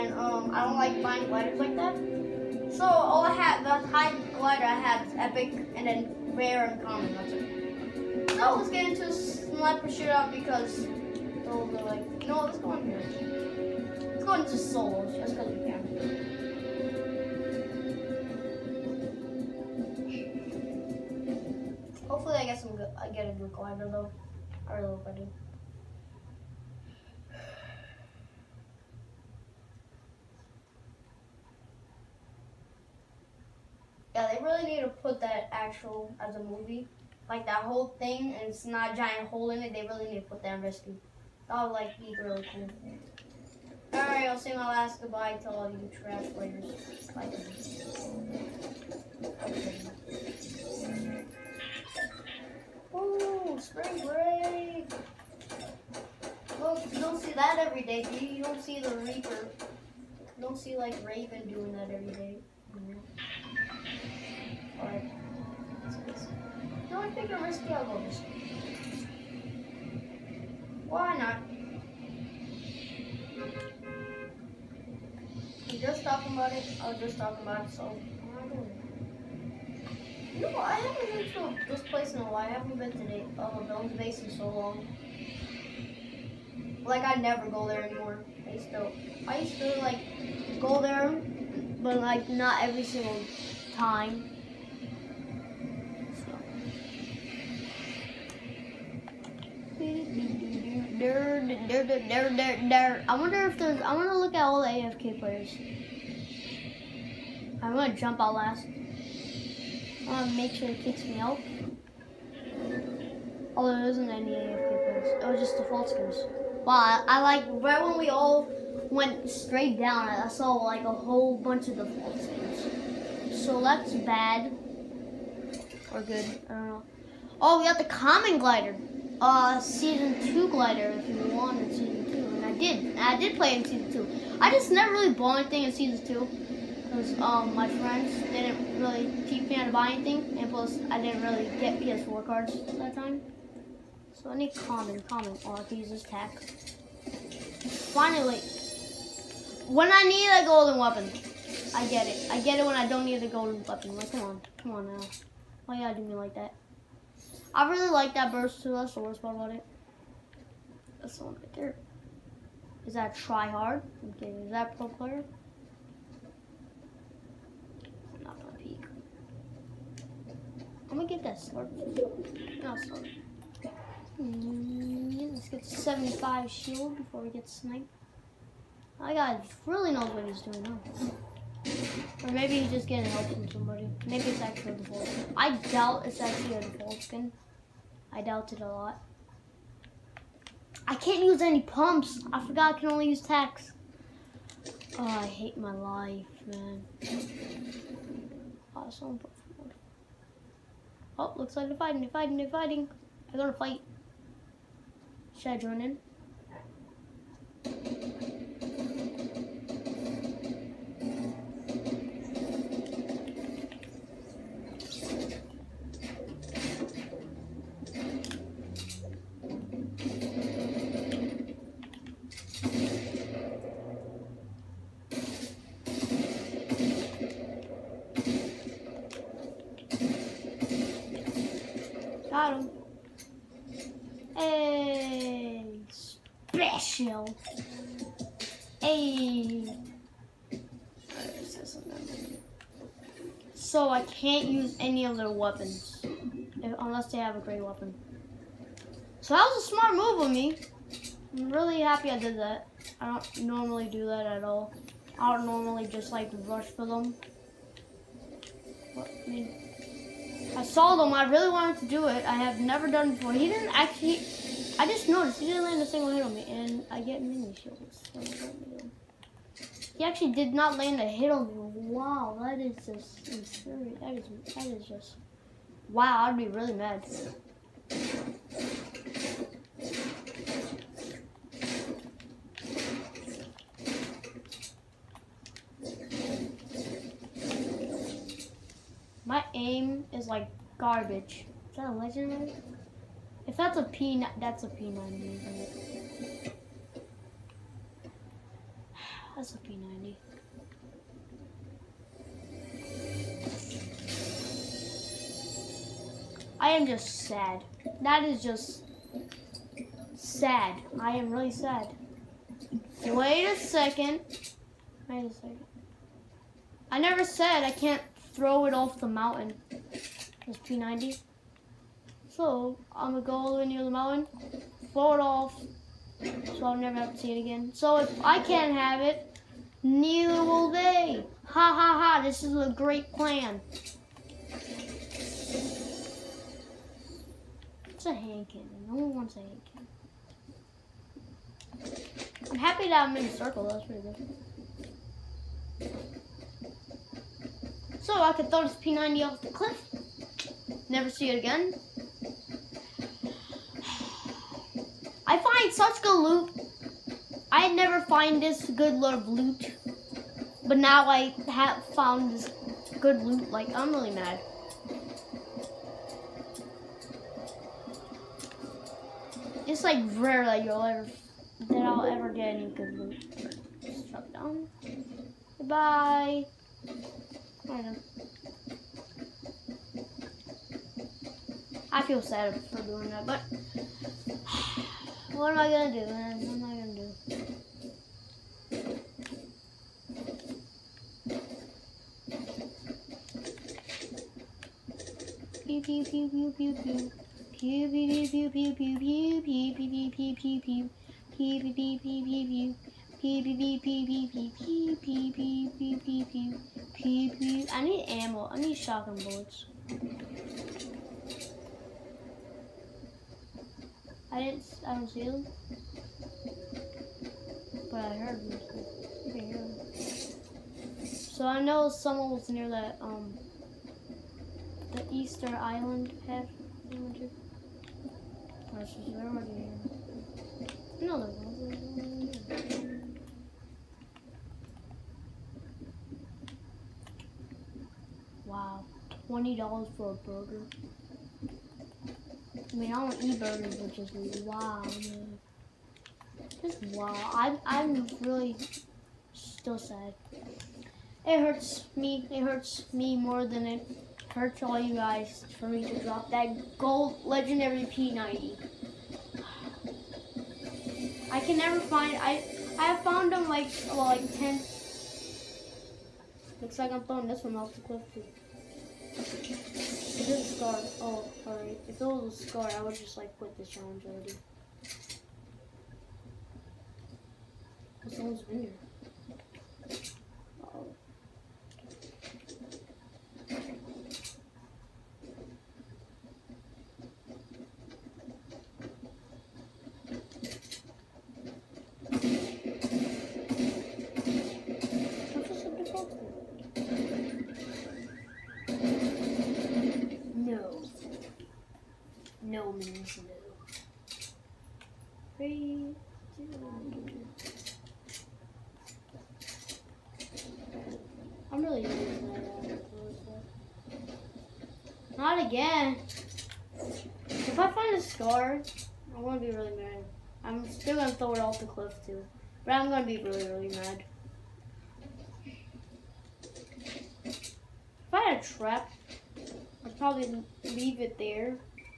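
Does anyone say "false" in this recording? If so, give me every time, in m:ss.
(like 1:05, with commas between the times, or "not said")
1:55, 2:01.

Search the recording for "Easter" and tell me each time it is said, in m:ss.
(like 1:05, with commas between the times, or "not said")
7:05.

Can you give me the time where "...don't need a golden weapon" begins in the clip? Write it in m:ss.
2:32.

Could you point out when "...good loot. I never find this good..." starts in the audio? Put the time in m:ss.
5:56.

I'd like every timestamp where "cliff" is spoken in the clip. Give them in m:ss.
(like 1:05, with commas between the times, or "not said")
5:49, 7:47, 8:41.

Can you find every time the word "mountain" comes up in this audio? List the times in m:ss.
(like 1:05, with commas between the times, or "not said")
5:19, 5:23.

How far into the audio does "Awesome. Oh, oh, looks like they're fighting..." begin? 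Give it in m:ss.
3:18.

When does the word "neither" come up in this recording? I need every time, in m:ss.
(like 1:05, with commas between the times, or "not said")
5:29.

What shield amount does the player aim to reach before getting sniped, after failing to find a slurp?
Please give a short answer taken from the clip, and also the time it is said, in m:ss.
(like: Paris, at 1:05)
75, at 2:55.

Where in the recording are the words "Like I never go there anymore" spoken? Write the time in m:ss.
1:26.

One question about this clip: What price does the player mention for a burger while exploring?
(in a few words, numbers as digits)
$20.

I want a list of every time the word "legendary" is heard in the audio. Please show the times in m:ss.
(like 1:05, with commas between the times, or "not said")
4:51, 7:37.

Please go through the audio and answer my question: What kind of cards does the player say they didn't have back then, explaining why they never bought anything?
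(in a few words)
PS4 cards.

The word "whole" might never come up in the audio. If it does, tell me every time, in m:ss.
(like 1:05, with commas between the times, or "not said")
0:37, 2:00.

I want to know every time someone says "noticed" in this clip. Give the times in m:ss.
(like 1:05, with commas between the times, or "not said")
4:25.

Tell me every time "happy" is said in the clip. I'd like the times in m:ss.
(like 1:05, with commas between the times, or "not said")
4:11, 5:42.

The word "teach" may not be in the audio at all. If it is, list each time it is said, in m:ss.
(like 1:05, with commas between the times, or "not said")
2:19.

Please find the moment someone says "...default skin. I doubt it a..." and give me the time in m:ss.
3:06.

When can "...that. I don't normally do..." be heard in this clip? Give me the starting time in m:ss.
4:12.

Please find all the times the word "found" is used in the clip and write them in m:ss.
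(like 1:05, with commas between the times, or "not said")
6:01, 7:43.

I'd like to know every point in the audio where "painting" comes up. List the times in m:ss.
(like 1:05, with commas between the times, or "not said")
not said.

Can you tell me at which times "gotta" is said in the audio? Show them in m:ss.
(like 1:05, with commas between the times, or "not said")
2:35, 3:23.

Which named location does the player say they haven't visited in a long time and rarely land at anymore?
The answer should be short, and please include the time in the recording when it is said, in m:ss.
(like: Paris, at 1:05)
Bones Basin, at 1:23.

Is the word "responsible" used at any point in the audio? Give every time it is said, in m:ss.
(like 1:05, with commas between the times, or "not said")
not said.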